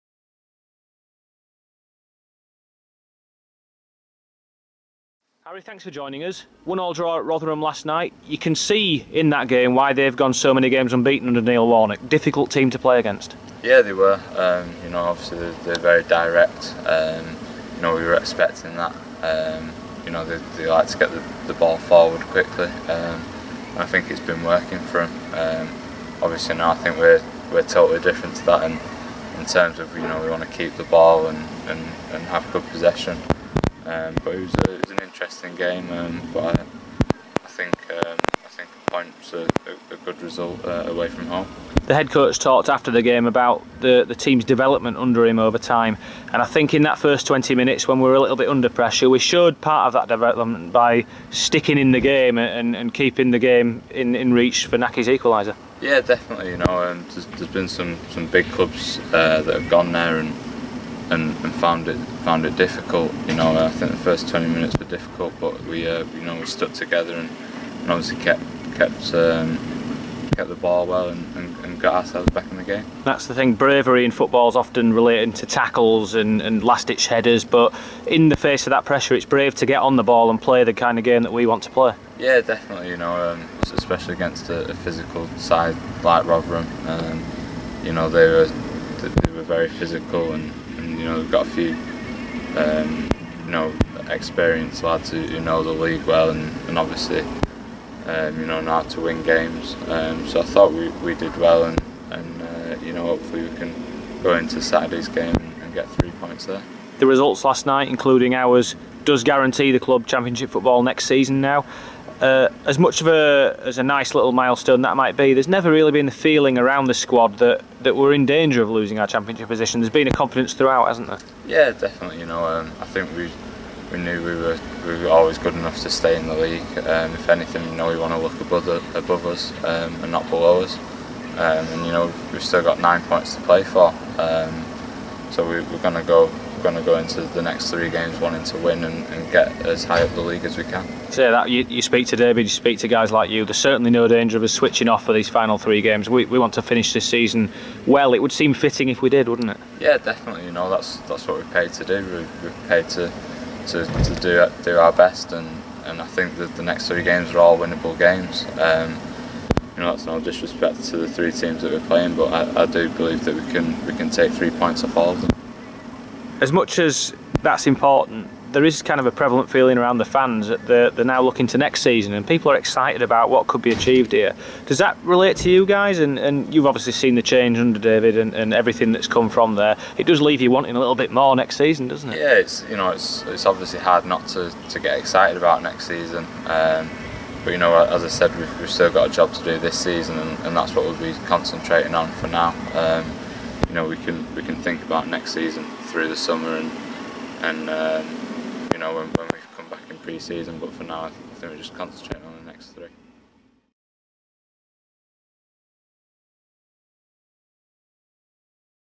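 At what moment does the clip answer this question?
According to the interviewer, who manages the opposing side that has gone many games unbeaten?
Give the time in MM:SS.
00:11.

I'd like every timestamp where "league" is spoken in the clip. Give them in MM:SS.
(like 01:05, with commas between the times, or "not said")
01:35, 02:06, 02:20.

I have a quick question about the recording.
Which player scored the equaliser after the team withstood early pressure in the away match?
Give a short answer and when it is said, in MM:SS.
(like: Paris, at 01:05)
Nahki, at 00:54.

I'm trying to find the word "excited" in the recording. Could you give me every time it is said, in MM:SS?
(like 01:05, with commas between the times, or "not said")
02:52, 03:04.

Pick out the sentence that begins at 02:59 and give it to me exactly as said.
It does leave you wanting a little bit more next season, doesn't it?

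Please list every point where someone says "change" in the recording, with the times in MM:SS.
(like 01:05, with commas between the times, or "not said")
02:57.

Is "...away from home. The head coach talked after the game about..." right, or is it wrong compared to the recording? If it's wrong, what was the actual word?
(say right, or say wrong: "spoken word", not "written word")
right.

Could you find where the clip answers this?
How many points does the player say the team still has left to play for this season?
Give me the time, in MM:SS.
02:12.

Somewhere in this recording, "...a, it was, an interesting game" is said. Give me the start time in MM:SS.
00:34.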